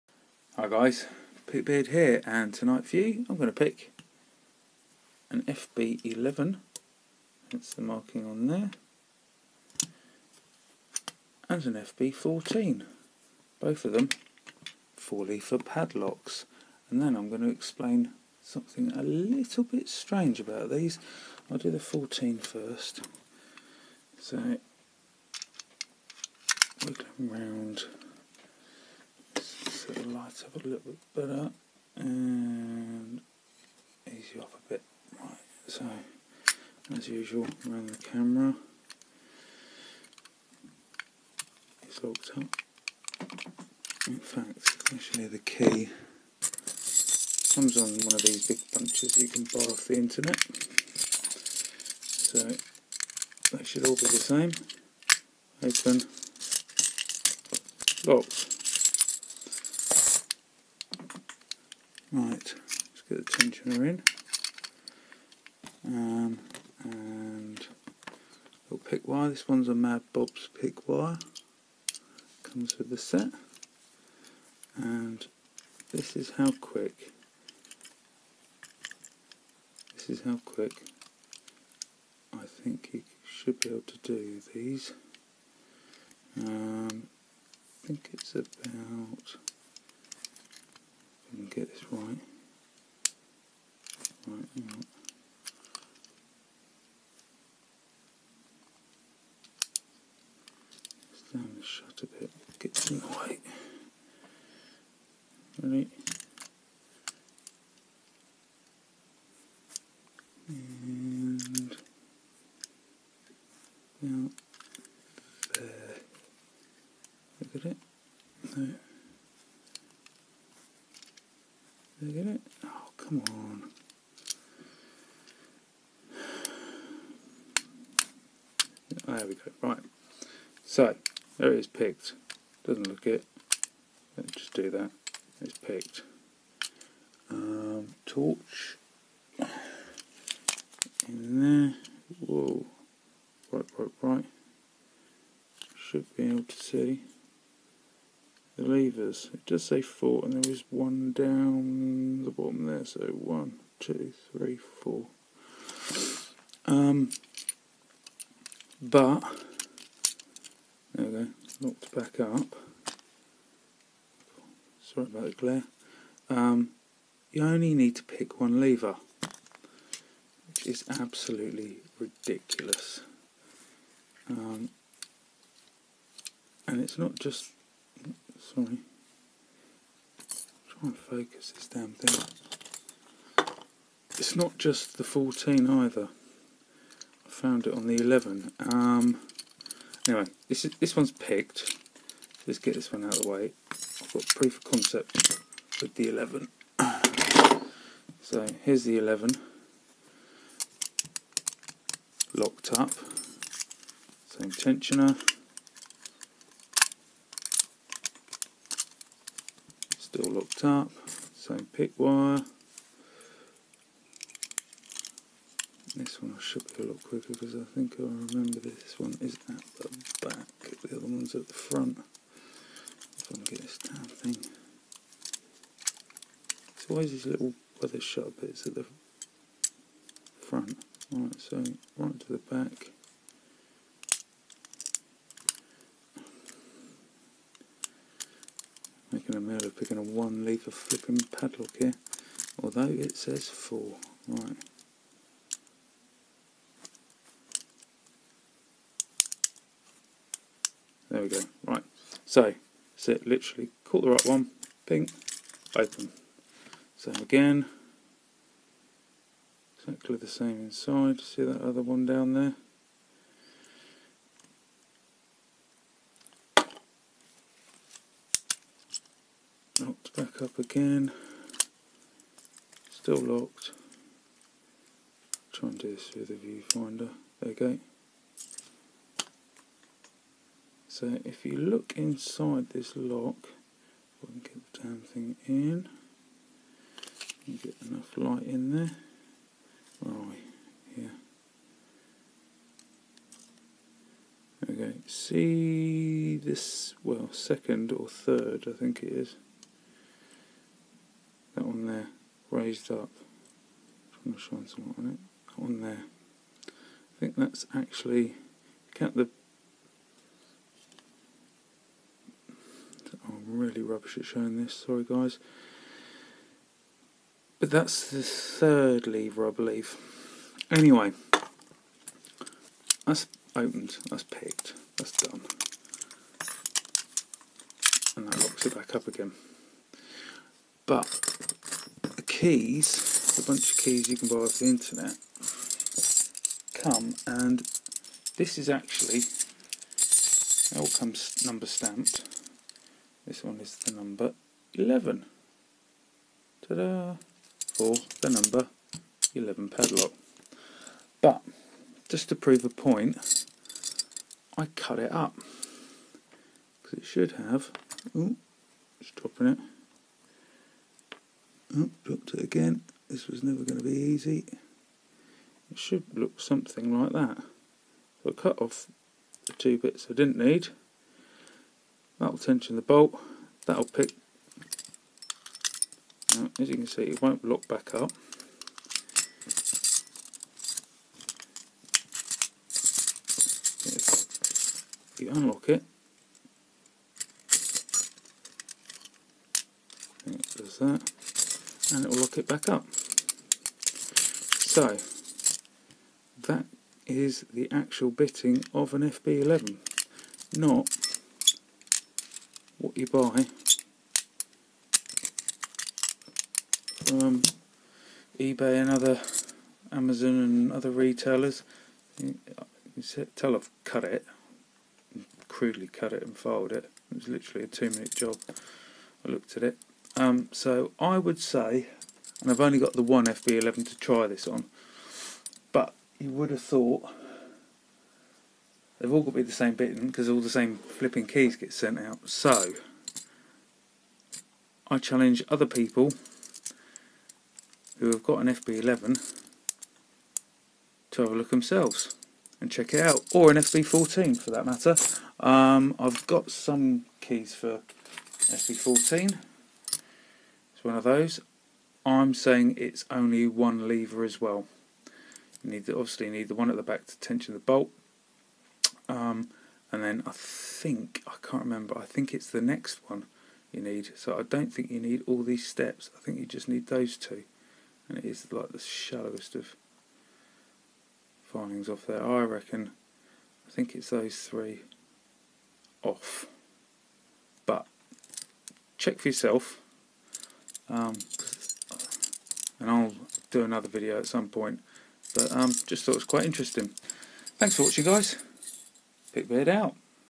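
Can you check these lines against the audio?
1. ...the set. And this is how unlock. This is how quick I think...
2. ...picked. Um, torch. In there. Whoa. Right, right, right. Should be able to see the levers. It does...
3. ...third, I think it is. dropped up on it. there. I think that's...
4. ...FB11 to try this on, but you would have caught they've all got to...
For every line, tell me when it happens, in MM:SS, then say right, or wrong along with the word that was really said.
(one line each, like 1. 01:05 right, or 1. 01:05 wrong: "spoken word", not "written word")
1. 01:12 wrong: "quick", not "unlock"
2. 02:15 right
3. 04:58 wrong: "raised", not "dropped"
4. 07:03 wrong: "thought", not "caught".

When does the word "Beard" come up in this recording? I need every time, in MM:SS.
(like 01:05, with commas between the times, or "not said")
00:01, 08:09.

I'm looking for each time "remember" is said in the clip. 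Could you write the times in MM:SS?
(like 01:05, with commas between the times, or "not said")
03:38, 07:41.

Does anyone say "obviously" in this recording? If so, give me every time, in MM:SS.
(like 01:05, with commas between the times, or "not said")
07:35.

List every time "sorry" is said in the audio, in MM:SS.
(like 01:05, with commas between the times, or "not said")
02:44, 02:58, 05:14.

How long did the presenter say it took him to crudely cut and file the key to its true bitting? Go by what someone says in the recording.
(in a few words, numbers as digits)
2 minutes.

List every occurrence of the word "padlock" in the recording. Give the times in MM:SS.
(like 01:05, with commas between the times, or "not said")
00:15, 04:01, 05:49.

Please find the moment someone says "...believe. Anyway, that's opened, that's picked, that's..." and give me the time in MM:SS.
05:19.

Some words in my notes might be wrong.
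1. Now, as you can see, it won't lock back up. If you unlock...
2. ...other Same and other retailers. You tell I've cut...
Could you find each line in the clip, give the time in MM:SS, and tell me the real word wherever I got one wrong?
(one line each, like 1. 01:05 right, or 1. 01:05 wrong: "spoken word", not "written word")
1. 06:16 right
2. 06:48 wrong: "Amazon", not "Same".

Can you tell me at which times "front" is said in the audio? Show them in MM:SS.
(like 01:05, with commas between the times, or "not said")
03:41, 03:50.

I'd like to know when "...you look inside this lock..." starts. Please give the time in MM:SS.
04:41.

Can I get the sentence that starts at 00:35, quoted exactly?
Right, so as usual around the camera it's locked up.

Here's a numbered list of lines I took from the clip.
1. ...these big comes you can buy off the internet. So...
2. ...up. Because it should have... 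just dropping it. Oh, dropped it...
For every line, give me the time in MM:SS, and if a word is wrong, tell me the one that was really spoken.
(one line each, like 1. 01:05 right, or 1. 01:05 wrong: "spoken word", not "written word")
1. 00:48 wrong: "bunches", not "comes"
2. 05:55 right.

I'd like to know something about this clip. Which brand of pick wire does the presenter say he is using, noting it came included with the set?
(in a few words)
Mad Bob's.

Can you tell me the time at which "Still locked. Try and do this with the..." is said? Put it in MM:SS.
04:32.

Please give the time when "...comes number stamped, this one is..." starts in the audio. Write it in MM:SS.
05:40.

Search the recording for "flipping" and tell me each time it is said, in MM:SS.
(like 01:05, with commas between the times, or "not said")
04:00, 07:10.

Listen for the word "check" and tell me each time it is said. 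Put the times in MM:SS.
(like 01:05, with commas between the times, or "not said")
07:22, 07:58.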